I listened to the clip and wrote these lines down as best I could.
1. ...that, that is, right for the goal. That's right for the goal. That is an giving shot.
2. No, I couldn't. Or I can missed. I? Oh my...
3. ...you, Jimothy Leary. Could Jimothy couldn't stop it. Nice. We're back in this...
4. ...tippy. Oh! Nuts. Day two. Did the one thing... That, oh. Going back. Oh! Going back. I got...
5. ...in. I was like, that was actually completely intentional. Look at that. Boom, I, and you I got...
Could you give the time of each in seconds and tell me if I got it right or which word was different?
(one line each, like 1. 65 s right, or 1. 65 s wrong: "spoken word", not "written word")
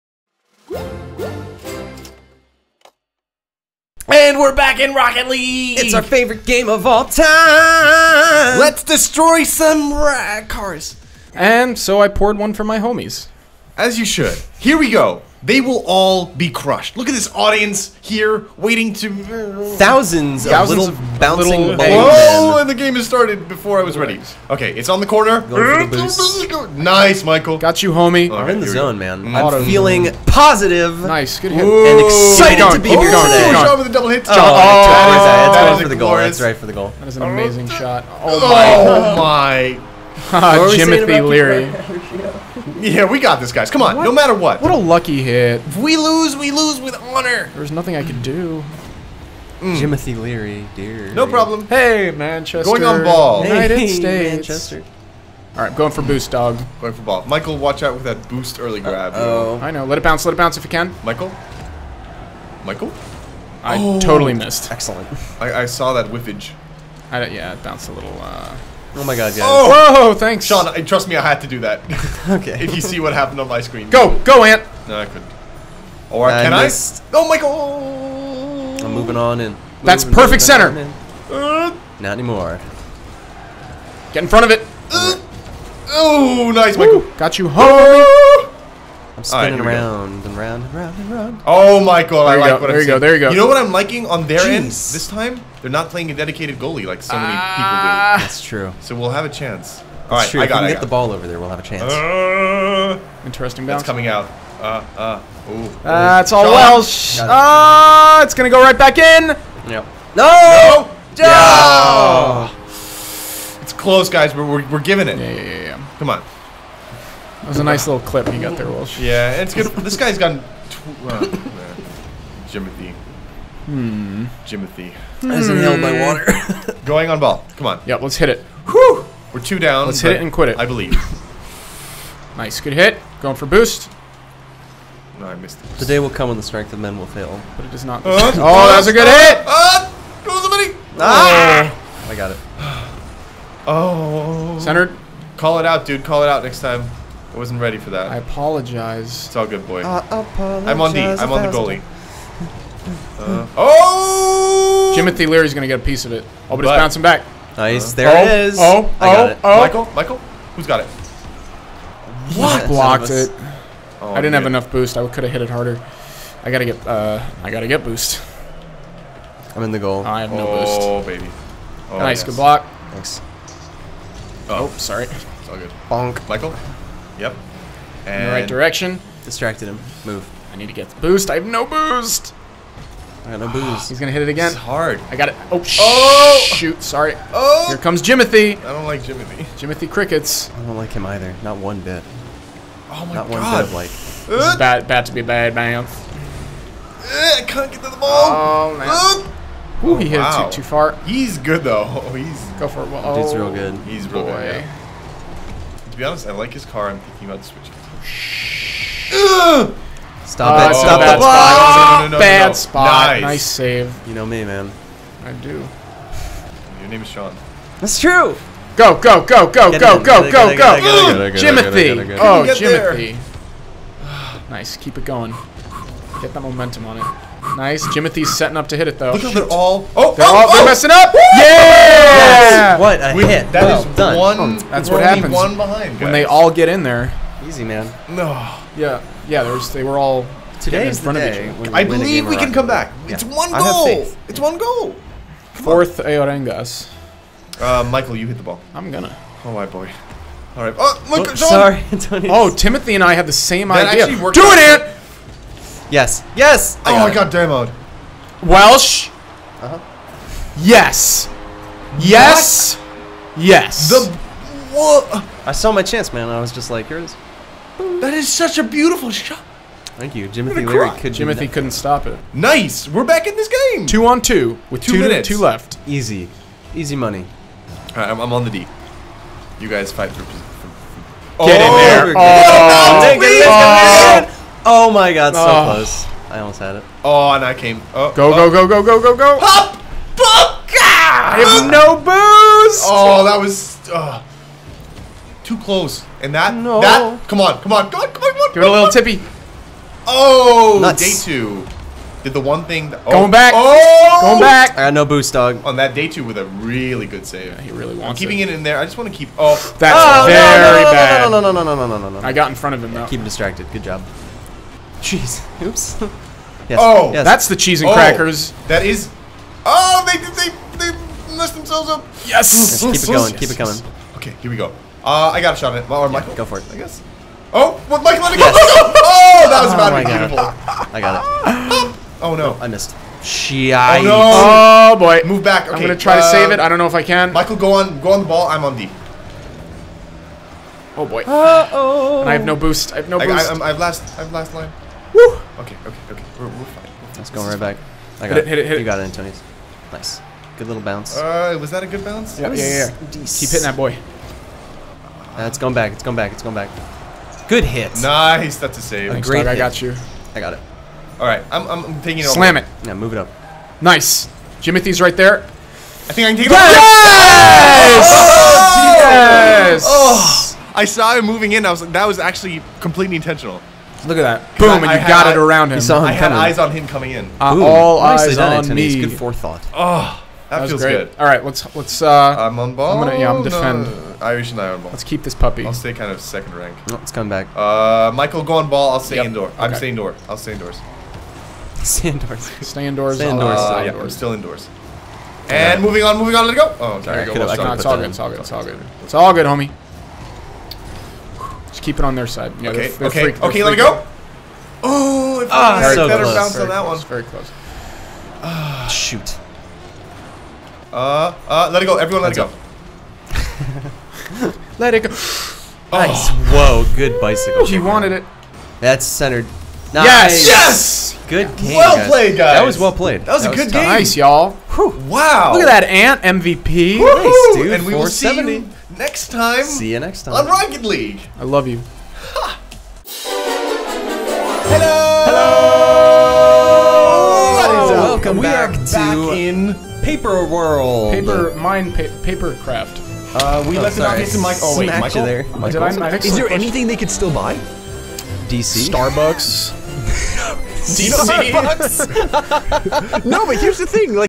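1. 34 s wrong: "amazing", not "giving"
2. 74 s right
3. 270 s right
4. 298 s right
5. 371 s right.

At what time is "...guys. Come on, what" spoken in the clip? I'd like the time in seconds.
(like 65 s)
43 s.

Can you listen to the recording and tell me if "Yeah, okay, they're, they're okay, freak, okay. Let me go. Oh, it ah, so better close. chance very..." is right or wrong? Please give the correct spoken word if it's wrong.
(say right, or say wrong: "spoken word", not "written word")
wrong: "bounce", not "chance".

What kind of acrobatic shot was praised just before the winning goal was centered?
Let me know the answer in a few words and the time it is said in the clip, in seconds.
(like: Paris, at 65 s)
bicycle, at 417 s.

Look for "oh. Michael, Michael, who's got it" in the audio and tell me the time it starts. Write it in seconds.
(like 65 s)
159 s.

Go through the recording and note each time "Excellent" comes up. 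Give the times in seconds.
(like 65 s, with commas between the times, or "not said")
64 s.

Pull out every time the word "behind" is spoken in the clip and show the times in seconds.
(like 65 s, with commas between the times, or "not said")
235 s.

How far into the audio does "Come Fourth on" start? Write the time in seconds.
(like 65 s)
245 s.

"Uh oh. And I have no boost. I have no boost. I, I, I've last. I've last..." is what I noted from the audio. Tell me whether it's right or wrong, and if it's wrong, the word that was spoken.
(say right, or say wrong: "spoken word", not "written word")
right.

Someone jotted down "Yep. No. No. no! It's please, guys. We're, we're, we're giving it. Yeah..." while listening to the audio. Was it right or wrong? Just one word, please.
wrong.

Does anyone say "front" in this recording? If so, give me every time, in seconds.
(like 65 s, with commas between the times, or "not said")
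84 s, 312 s.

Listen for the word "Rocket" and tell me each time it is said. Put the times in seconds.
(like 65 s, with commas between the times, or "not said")
4 s, 430 s.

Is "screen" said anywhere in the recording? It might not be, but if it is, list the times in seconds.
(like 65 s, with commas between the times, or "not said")
73 s.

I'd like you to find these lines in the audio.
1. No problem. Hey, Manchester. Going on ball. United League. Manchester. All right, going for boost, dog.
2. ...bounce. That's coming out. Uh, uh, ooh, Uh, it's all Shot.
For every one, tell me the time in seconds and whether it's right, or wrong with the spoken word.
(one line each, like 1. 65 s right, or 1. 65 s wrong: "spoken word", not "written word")
1. 51 s wrong: "States", not "League"
2. 103 s right.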